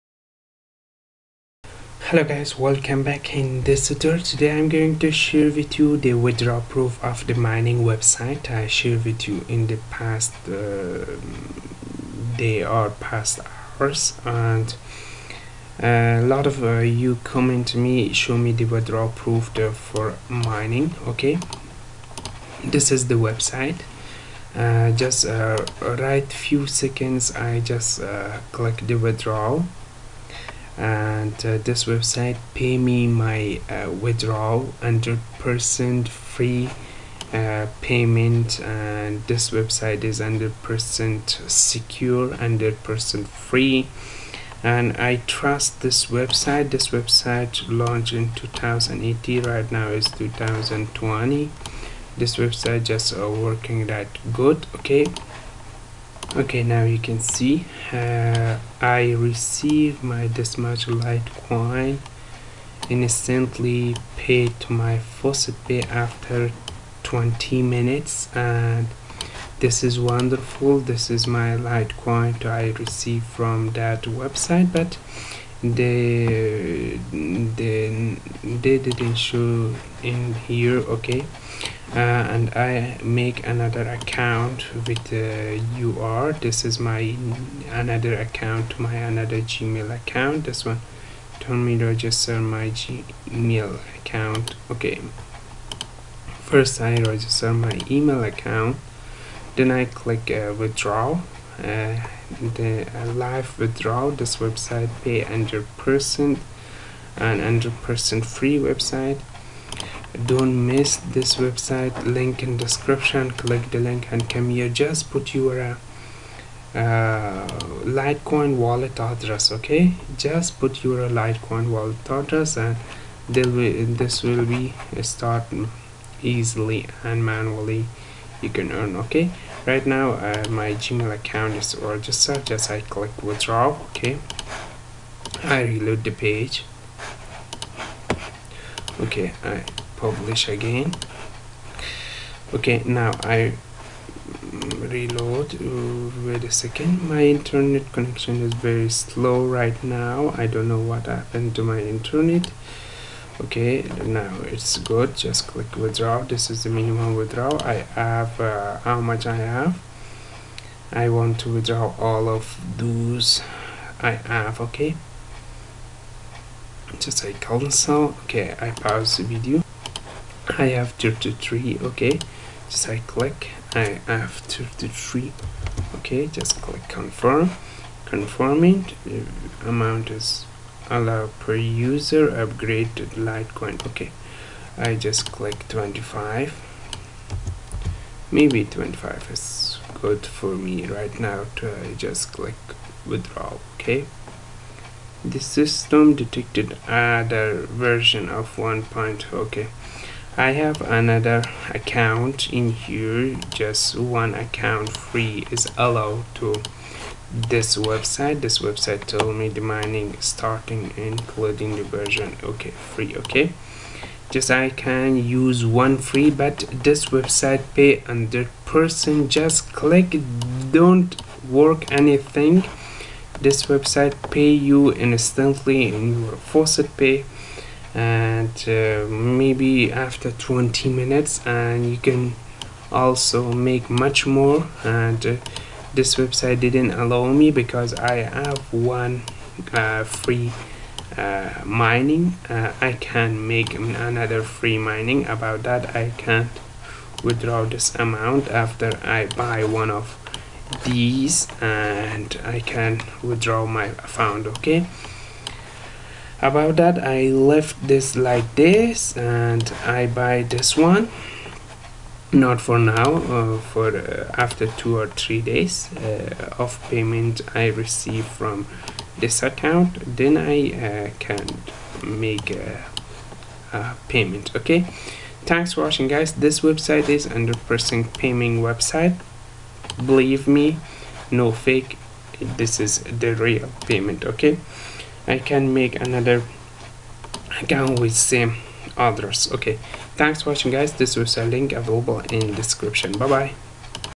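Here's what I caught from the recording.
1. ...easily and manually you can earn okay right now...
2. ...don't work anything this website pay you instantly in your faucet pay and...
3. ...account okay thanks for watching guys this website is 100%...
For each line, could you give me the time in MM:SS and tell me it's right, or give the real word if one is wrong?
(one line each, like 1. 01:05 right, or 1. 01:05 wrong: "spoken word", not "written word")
1. 02:06 right
2. 03:40 right
3. 04:34 wrong: "payment", not "account".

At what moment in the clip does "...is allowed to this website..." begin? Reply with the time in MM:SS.
03:25.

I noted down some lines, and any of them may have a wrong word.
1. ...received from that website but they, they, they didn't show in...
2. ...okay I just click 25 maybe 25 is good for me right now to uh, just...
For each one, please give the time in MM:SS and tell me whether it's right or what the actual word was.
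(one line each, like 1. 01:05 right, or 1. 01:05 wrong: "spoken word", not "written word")
1. 01:12 right
2. 03:03 right.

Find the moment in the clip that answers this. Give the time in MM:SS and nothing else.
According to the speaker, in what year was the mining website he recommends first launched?
00:48.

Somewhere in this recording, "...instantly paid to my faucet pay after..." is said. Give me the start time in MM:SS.
01:02.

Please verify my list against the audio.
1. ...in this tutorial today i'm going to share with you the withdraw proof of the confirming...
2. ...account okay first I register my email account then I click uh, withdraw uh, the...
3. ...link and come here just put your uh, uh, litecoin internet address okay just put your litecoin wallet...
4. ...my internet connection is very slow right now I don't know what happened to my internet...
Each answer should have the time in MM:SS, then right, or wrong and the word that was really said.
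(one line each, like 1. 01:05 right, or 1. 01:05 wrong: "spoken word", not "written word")
1. 00:03 wrong: "mining", not "confirming"
2. 01:33 right
3. 01:53 wrong: "wallet", not "internet"
4. 02:27 right.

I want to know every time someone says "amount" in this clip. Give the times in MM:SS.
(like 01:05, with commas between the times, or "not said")
02:59, 04:07.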